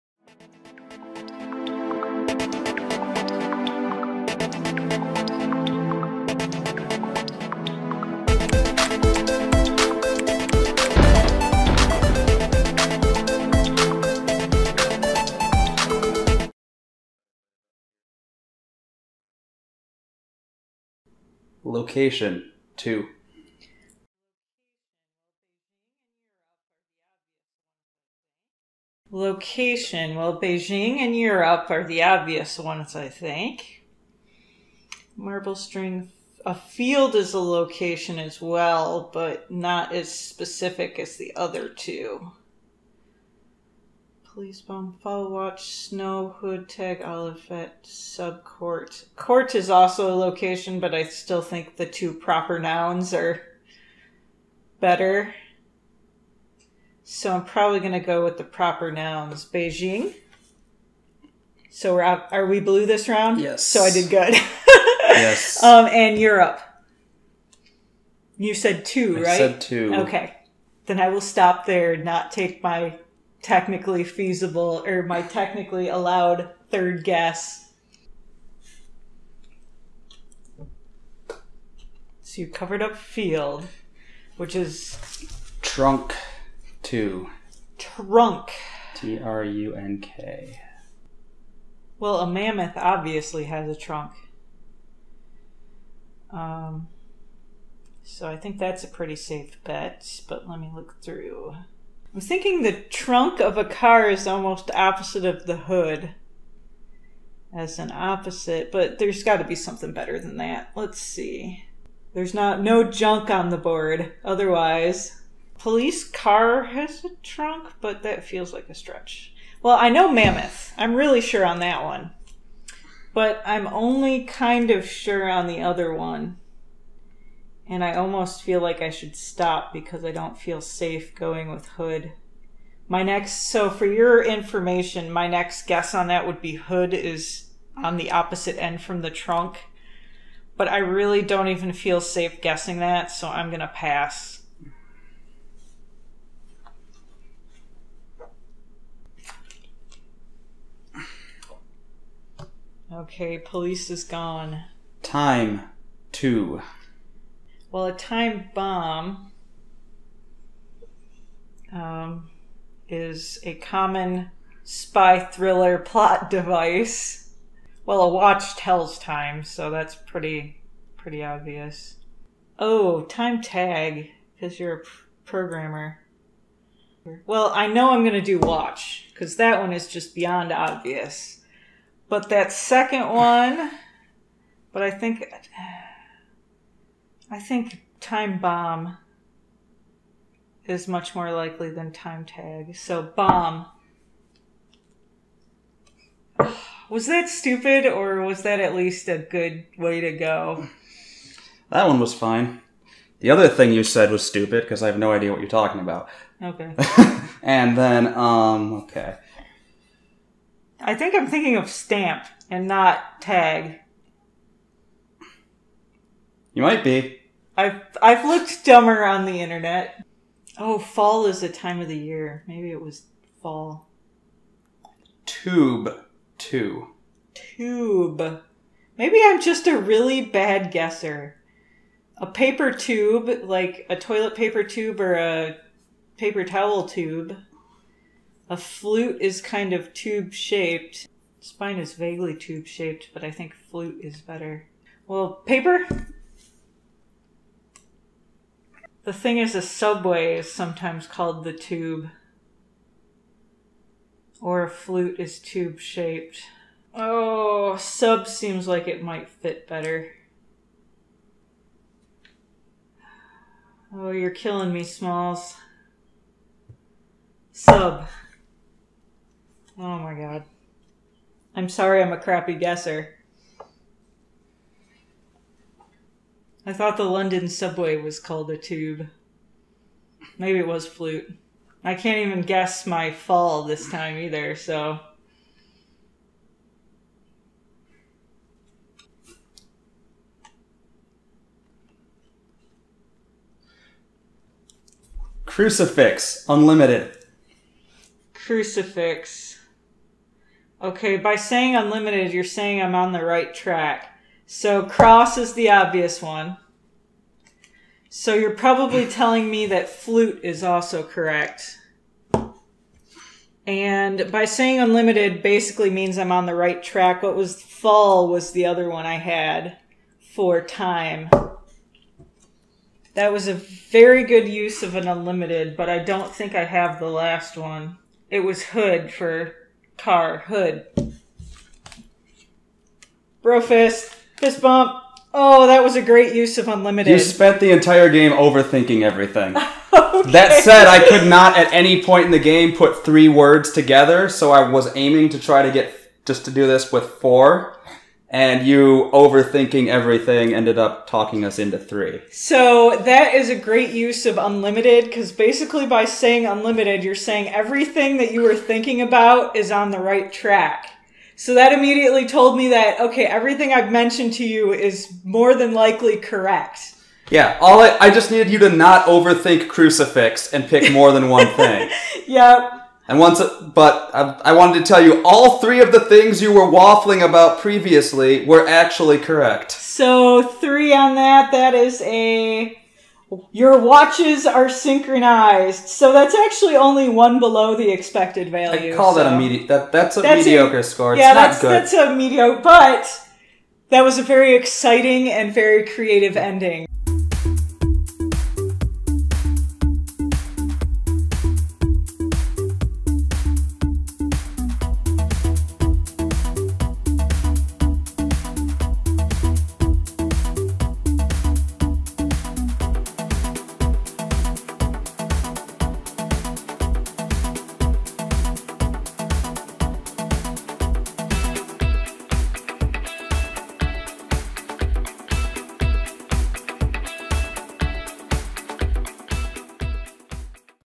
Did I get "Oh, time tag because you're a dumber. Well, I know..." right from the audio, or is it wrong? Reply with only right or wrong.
wrong.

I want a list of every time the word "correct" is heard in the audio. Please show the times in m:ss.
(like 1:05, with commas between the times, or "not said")
5:11, 6:06, 6:19.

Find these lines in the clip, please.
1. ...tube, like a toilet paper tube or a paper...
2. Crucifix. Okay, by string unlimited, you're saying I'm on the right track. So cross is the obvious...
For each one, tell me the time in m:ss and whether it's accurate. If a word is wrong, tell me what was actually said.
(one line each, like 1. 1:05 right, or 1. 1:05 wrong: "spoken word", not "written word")
1. 3:52 right
2. 4:58 wrong: "saying", not "string".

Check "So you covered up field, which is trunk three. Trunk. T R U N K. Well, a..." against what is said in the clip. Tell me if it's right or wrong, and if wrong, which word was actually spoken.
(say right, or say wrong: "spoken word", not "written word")
wrong: "two", not "three".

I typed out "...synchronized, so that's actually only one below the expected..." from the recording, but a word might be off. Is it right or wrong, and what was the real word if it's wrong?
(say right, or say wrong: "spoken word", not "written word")
right.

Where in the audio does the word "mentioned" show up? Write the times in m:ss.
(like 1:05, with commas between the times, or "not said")
6:03.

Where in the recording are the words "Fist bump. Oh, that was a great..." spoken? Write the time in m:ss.
5:34.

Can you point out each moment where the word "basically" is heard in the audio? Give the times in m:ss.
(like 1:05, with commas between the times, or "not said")
5:15, 5:55.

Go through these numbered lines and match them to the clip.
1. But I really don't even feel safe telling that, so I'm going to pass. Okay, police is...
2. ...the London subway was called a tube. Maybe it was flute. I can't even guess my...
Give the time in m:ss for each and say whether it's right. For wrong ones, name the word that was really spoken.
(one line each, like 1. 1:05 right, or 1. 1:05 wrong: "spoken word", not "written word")
1. 2:20 wrong: "guessing", not "telling"
2. 4:36 right.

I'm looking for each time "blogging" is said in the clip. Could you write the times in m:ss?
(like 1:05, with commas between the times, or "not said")
not said.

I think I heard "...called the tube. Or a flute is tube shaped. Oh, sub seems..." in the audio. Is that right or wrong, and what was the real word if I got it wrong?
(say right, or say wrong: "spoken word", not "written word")
right.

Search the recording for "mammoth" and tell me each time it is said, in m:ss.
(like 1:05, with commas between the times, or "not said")
1:32, 2:00.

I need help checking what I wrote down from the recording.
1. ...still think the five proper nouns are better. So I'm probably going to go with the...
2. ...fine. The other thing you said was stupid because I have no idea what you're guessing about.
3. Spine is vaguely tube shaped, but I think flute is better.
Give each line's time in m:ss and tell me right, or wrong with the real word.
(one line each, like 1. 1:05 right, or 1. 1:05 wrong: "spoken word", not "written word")
1. 0:51 wrong: "two", not "five"
2. 3:22 wrong: "talking", not "guessing"
3. 4:01 right.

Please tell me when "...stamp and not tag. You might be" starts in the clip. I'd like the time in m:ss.
3:31.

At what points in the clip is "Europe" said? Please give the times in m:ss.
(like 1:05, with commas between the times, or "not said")
0:31, 1:06.